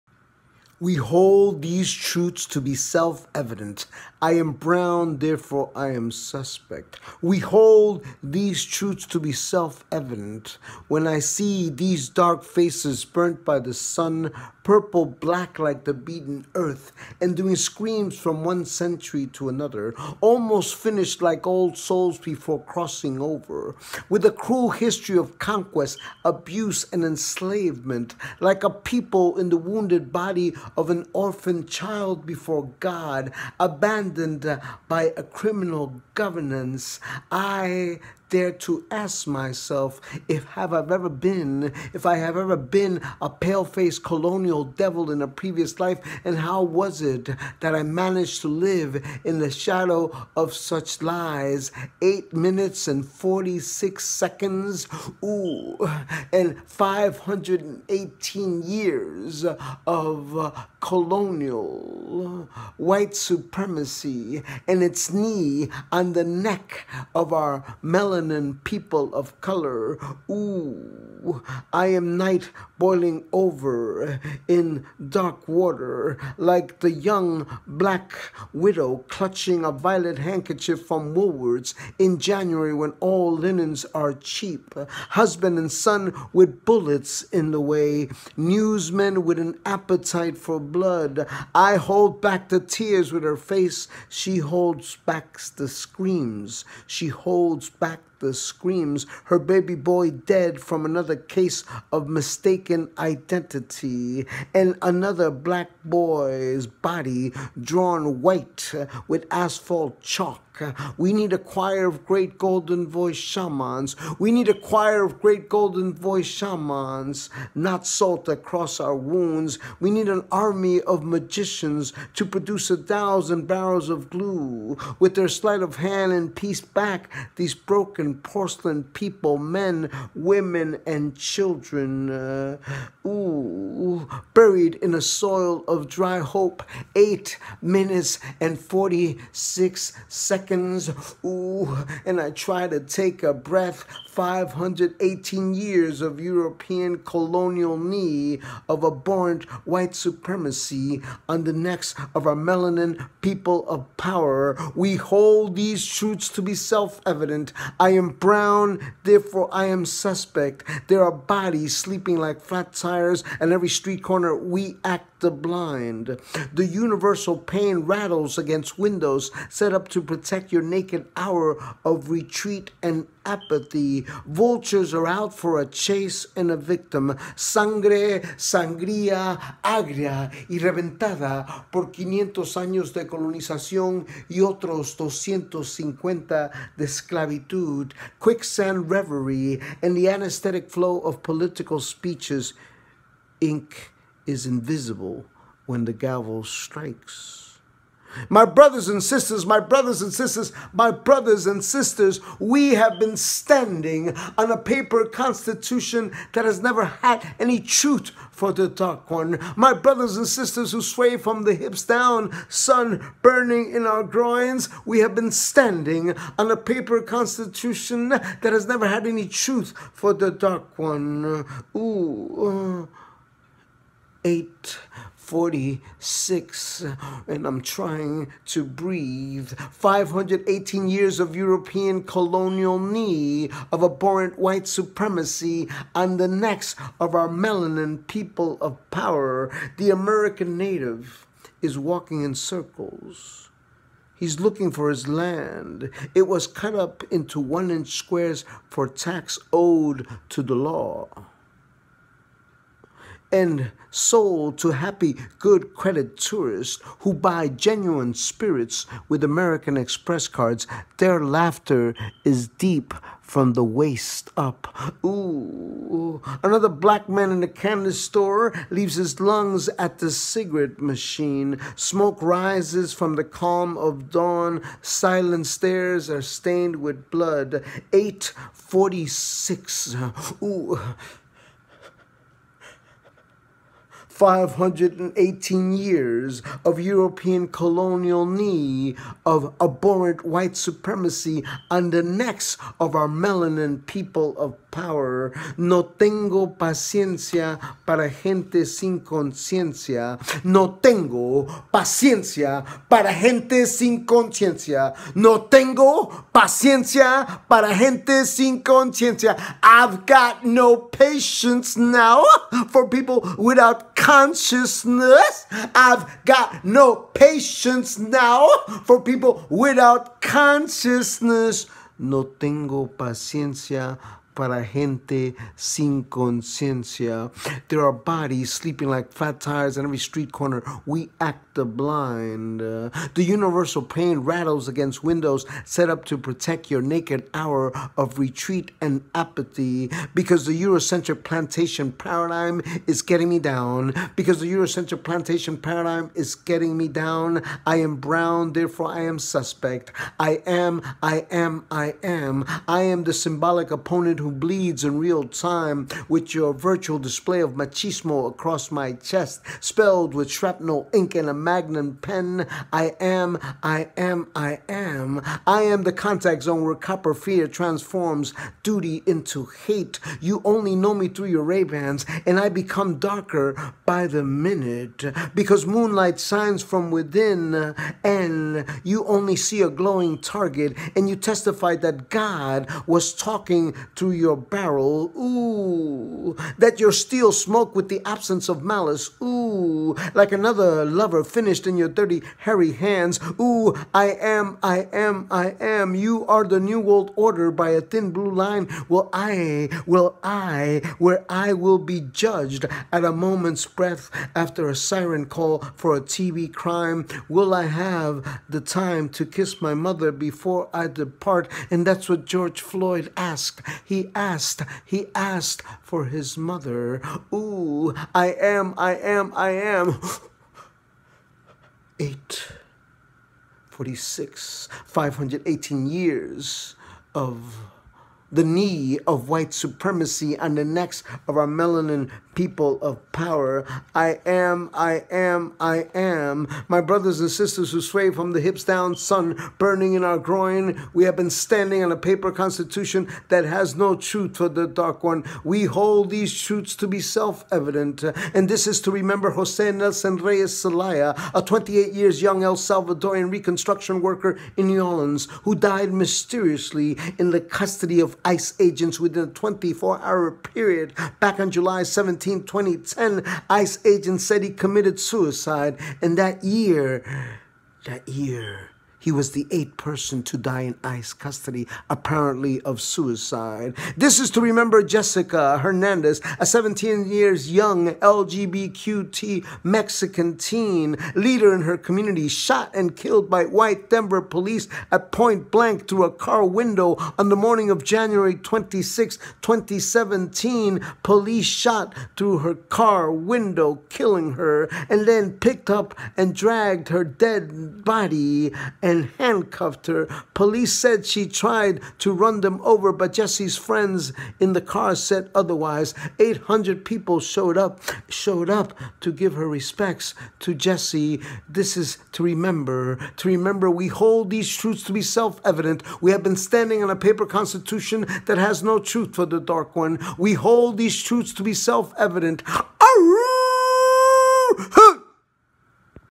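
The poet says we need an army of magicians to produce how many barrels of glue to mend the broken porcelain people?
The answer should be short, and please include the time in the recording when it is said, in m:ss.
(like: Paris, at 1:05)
1000, at 2:02.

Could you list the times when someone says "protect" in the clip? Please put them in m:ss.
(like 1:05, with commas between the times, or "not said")
2:50, 5:36.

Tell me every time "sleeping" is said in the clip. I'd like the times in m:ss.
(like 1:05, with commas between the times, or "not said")
2:41, 5:28.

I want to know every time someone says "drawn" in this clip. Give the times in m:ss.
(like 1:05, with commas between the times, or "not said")
1:47.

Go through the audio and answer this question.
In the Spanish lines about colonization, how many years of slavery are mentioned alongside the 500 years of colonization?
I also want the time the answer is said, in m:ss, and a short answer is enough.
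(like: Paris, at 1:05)
250, at 3:04.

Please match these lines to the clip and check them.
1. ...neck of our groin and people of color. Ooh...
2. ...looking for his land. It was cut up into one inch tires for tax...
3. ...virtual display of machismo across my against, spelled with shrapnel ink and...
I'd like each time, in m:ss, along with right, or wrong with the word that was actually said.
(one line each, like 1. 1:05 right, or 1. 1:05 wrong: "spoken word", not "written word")
1. 1:06 wrong: "melanin", not "groin"
2. 4:04 wrong: "squares", not "tires"
3. 5:56 wrong: "chest", not "against".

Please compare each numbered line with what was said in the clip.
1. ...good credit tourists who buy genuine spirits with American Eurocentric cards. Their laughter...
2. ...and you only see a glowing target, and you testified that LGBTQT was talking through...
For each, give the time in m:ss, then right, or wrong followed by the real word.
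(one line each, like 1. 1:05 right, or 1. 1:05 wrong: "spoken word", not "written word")
1. 4:15 wrong: "Express", not "Eurocentric"
2. 6:18 wrong: "God", not "LGBTQT".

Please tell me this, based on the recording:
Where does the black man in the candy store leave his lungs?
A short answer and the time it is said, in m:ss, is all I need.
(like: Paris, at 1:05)
the cigarette machine, at 4:29.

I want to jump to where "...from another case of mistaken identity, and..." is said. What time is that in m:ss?
1:40.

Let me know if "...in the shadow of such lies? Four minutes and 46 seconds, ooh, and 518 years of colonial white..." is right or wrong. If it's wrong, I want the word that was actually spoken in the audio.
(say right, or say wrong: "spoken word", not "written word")
wrong: "Eight", not "Four".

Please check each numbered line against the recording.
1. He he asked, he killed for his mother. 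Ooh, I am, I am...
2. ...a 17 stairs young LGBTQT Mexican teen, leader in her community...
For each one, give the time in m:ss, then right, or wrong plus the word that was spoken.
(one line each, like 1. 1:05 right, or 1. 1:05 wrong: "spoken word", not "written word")
1. 6:53 wrong: "asked", not "killed"
2. 7:56 wrong: "years", not "stairs".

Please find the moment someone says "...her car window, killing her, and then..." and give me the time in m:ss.
8:12.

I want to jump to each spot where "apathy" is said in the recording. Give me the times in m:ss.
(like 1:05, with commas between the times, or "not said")
2:53, 5:39.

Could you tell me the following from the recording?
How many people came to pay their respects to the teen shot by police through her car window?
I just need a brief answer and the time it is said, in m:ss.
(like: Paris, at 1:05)
800, at 8:26.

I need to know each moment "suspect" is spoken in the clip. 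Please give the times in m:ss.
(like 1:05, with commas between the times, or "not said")
0:06, 2:39, 5:49.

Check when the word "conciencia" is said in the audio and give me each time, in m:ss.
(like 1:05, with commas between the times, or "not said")
4:59, 5:04, 5:08, 5:26.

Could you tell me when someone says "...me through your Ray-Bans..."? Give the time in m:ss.
6:10.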